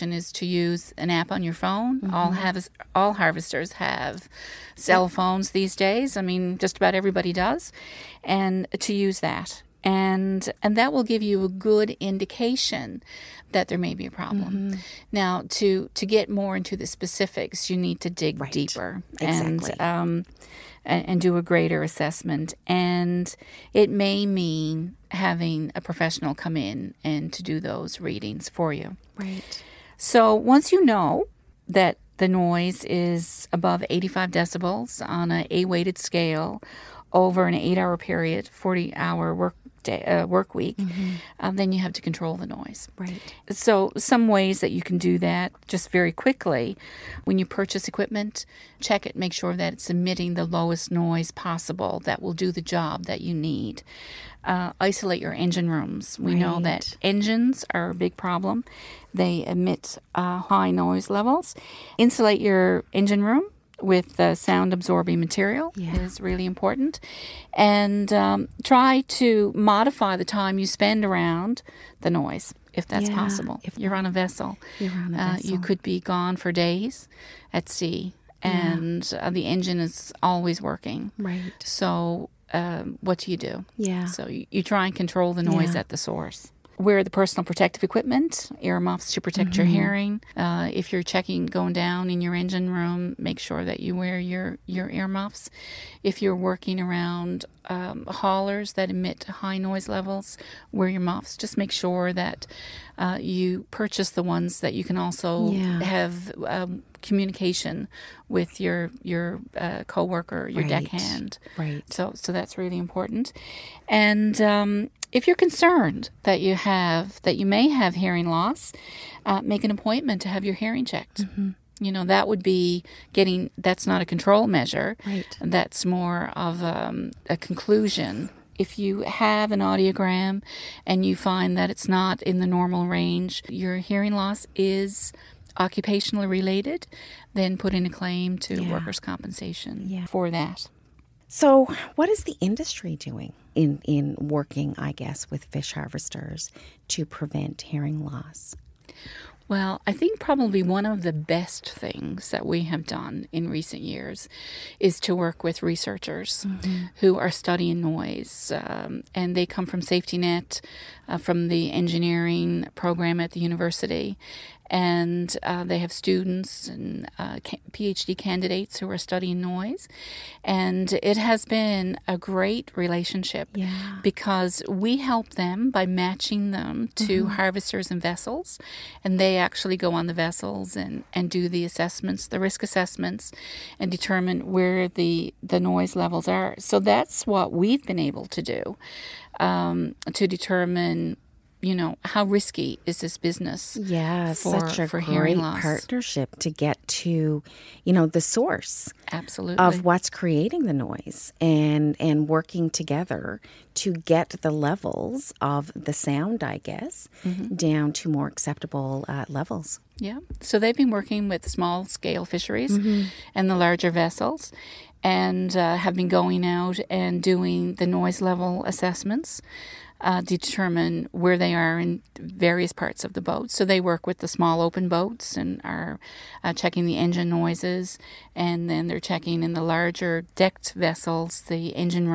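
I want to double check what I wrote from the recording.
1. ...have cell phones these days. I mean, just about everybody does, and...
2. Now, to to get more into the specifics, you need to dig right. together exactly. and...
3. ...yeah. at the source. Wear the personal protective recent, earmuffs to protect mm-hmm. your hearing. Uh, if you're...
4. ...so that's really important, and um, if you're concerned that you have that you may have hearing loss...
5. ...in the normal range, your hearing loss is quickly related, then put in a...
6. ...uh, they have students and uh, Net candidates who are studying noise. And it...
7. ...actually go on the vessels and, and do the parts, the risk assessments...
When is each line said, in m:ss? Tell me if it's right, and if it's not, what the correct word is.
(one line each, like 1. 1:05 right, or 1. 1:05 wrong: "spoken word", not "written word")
1. 0:03 right
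2. 0:15 wrong: "deeper", not "together"
3. 1:25 wrong: "equipment", not "recent"
4. 1:52 right
5. 2:12 wrong: "occupationally", not "quickly"
6. 2:45 wrong: "PhD", not "Net"
7. 2:59 wrong: "assessments", not "parts".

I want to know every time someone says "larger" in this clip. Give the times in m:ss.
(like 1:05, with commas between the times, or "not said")
3:33, 3:49.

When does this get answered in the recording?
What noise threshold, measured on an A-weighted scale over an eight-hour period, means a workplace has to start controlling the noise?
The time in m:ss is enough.
0:33.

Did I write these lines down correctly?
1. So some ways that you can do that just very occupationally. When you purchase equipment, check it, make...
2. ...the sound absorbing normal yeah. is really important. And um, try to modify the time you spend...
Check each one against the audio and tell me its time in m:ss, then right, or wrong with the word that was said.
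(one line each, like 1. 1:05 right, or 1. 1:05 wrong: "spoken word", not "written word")
1. 0:43 wrong: "quickly", not "occupationally"
2. 1:04 wrong: "material", not "normal".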